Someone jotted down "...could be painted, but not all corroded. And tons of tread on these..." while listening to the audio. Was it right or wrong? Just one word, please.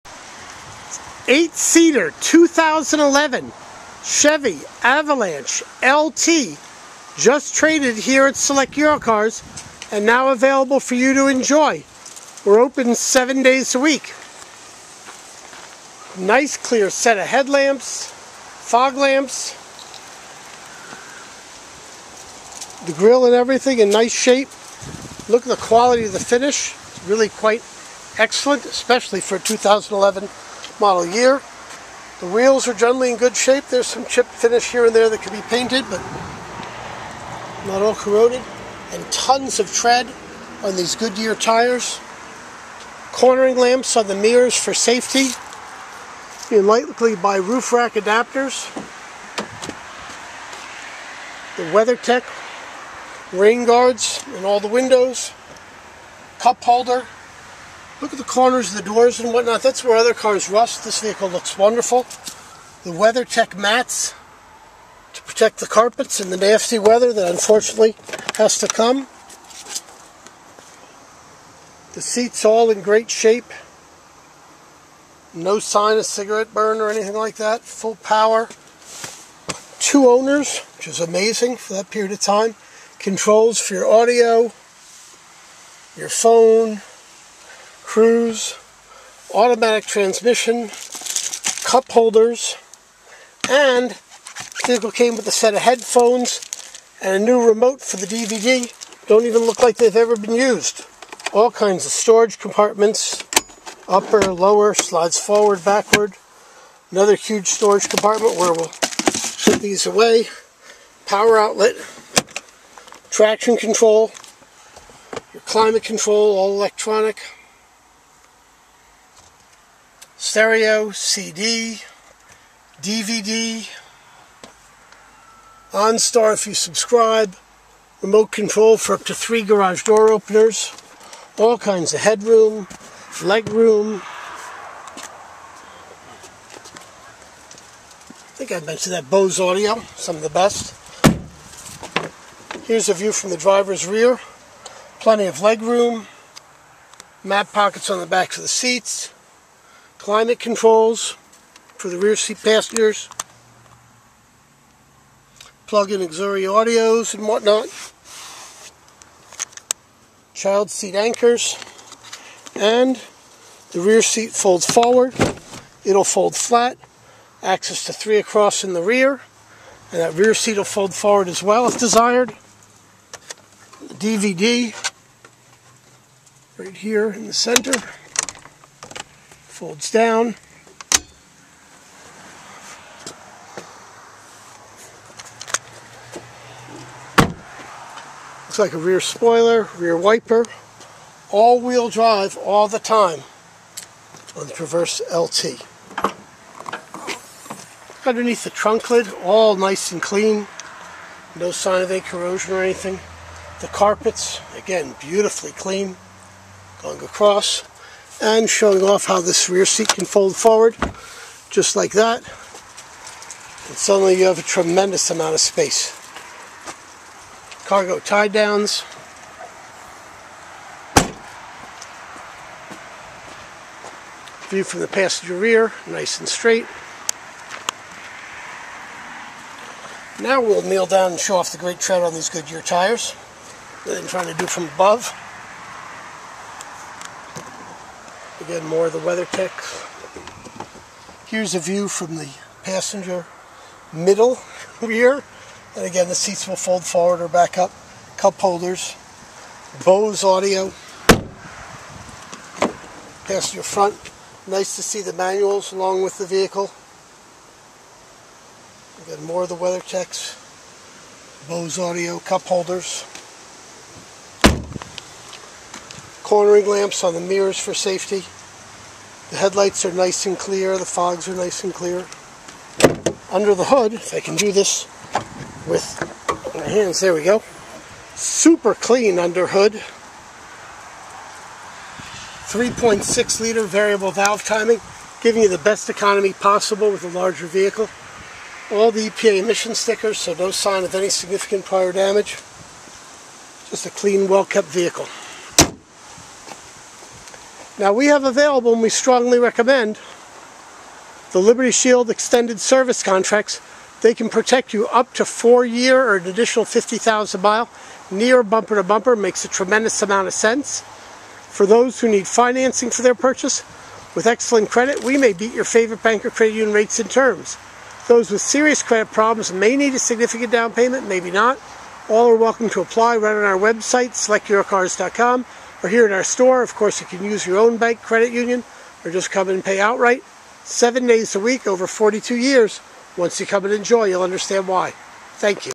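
right.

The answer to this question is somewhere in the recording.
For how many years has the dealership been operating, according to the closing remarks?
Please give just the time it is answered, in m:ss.
5:31.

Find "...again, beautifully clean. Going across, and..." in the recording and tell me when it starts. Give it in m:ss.
3:24.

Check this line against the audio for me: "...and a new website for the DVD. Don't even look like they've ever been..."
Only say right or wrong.
wrong.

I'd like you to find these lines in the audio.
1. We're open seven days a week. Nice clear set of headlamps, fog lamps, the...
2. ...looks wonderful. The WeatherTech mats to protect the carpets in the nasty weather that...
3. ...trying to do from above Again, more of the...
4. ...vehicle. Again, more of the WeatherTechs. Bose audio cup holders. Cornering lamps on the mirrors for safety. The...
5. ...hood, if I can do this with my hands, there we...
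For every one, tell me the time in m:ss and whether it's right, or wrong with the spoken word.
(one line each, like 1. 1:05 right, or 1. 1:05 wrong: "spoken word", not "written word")
1. 0:12 right
2. 1:01 right
3. 3:54 right
4. 4:16 right
5. 4:33 right.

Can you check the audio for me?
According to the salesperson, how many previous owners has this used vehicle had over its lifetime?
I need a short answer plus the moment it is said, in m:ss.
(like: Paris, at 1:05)
2, at 1:19.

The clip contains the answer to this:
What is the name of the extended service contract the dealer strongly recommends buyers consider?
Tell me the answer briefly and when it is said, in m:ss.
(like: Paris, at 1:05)
Liberty Shield, at 5:01.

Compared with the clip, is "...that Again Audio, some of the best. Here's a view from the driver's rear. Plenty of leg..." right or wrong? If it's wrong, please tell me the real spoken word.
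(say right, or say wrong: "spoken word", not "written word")
wrong: "Bose", not "Again".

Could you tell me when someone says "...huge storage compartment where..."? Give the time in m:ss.
1:47.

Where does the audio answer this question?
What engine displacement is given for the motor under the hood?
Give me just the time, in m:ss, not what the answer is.
4:42.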